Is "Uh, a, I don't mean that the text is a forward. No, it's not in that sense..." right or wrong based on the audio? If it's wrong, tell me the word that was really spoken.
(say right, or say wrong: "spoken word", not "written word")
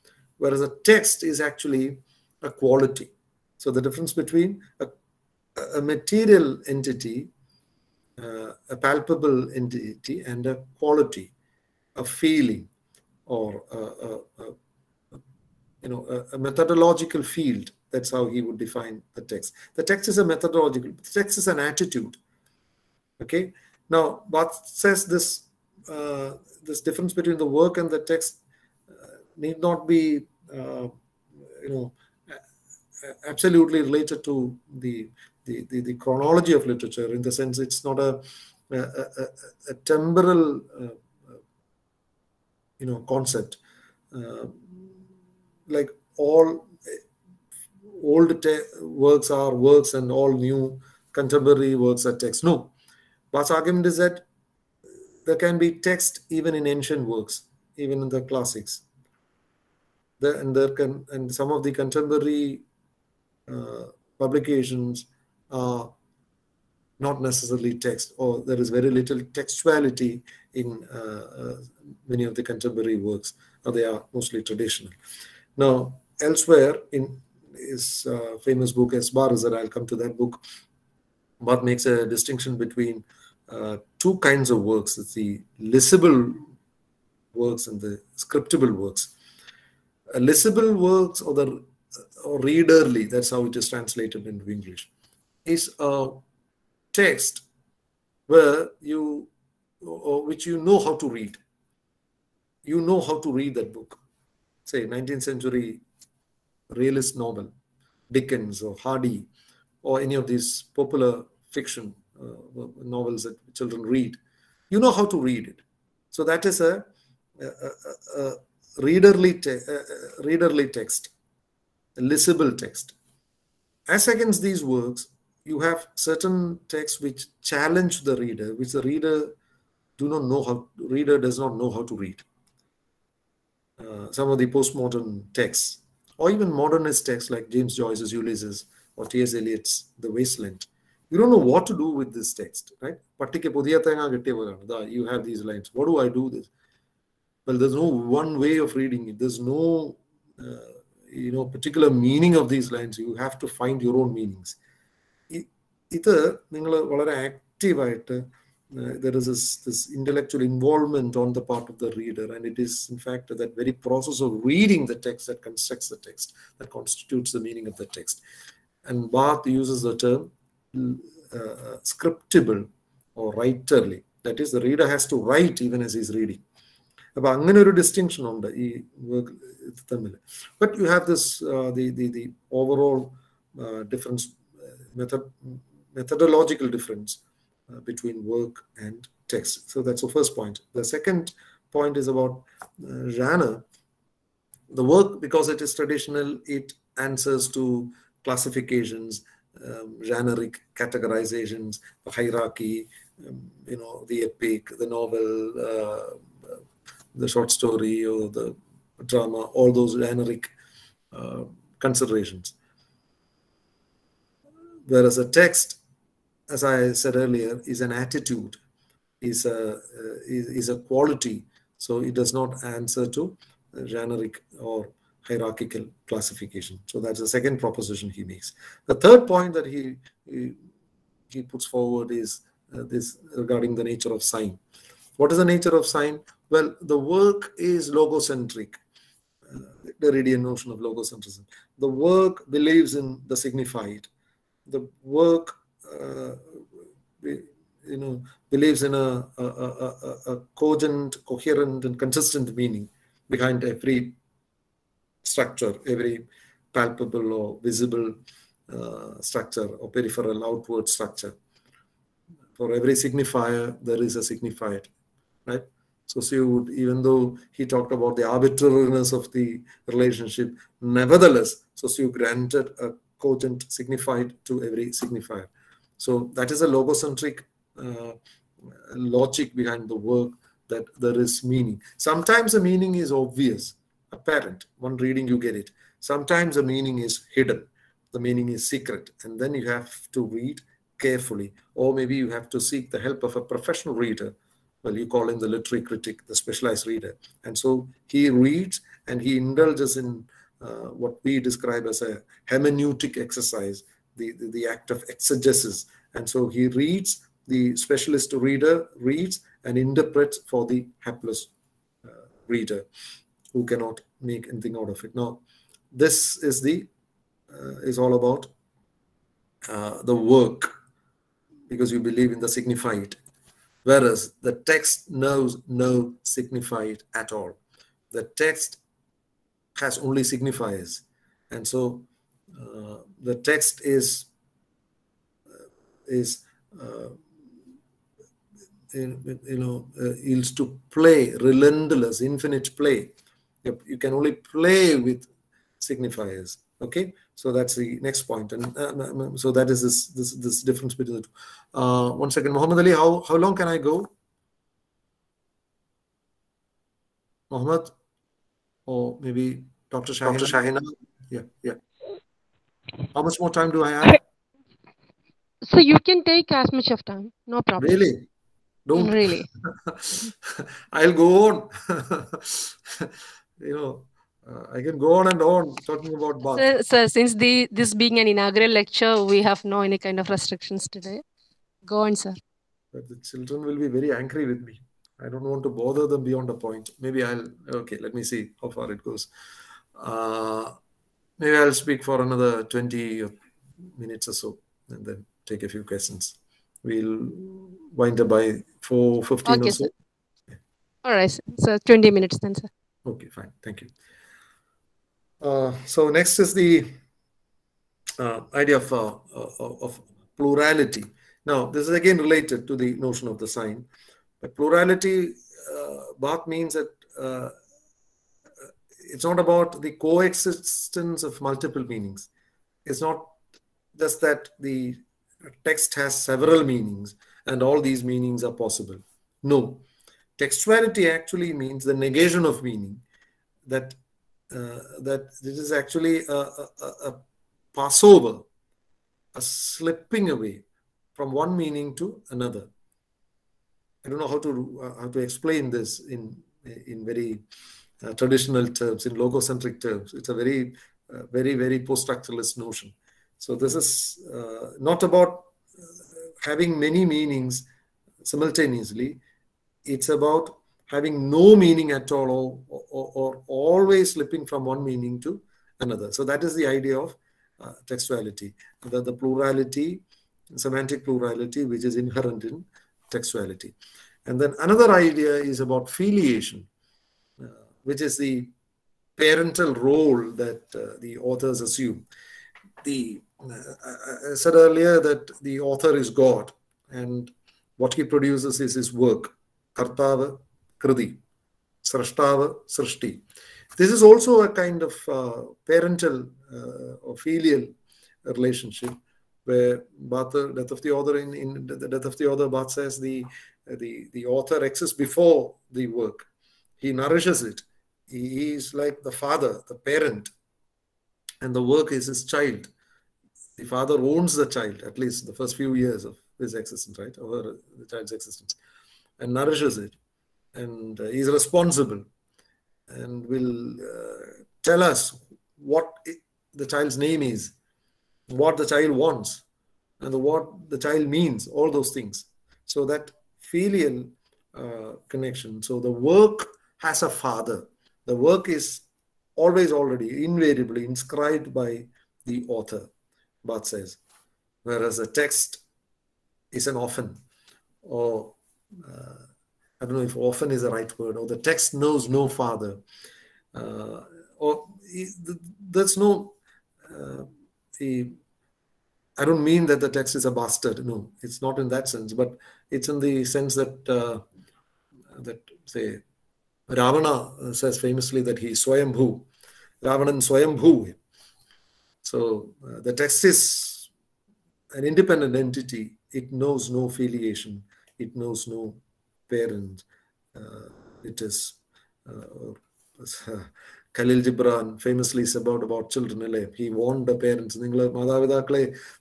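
wrong: "bastard", not "forward".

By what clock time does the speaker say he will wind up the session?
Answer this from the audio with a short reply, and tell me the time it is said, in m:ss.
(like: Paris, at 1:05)
4.15, at 6:38.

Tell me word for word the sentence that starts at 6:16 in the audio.
Sir, sir, since the this being an inaugural lecture, we have no any kind of restrictions today.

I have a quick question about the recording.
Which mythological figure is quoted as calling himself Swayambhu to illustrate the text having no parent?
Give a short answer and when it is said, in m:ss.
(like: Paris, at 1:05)
Ravana, at 9:26.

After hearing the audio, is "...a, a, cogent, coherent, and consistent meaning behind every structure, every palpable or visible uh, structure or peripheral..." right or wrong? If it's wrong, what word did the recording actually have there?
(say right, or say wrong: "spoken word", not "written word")
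right.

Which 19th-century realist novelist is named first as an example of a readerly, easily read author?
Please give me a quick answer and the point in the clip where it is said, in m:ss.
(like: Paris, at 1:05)
Dickens, at 1:48.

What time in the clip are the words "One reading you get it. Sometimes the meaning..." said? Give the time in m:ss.
4:44.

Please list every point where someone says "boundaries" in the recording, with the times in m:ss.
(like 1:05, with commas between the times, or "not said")
not said.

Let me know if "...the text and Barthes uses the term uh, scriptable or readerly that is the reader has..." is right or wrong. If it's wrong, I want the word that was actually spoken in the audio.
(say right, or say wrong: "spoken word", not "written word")
wrong: "writerly", not "readerly".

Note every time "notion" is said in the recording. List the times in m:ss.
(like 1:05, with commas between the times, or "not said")
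4:00, 6:52, 7:32.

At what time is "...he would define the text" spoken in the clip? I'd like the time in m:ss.
0:18.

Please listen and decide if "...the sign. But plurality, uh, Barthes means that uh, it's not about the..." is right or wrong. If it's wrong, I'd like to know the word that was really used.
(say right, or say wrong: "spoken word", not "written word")
right.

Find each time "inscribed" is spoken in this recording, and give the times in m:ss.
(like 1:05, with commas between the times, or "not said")
9:00.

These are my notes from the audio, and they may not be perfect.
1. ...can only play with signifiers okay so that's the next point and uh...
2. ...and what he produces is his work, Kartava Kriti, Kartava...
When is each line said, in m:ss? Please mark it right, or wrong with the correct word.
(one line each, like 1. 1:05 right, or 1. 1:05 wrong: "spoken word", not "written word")
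1. 5:43 right
2. 8:06 wrong: "Srashtava", not "Kartava".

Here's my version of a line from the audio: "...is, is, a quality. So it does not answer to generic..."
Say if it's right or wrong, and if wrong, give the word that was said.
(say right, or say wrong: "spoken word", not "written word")
right.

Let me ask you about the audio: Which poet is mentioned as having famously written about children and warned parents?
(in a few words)
Khalil Gibran.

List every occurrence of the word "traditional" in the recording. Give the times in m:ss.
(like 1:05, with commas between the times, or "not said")
1:14, 3:15, 7:28.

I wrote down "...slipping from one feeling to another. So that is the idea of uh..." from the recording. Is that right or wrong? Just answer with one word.
wrong.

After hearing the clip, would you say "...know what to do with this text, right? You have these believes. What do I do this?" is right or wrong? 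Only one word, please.
wrong.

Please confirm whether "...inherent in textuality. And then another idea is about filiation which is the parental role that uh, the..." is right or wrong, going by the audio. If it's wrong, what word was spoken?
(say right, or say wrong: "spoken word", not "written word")
right.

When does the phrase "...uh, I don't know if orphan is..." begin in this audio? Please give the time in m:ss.
9:08.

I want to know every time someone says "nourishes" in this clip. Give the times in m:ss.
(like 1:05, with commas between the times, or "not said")
8:26, 8:39.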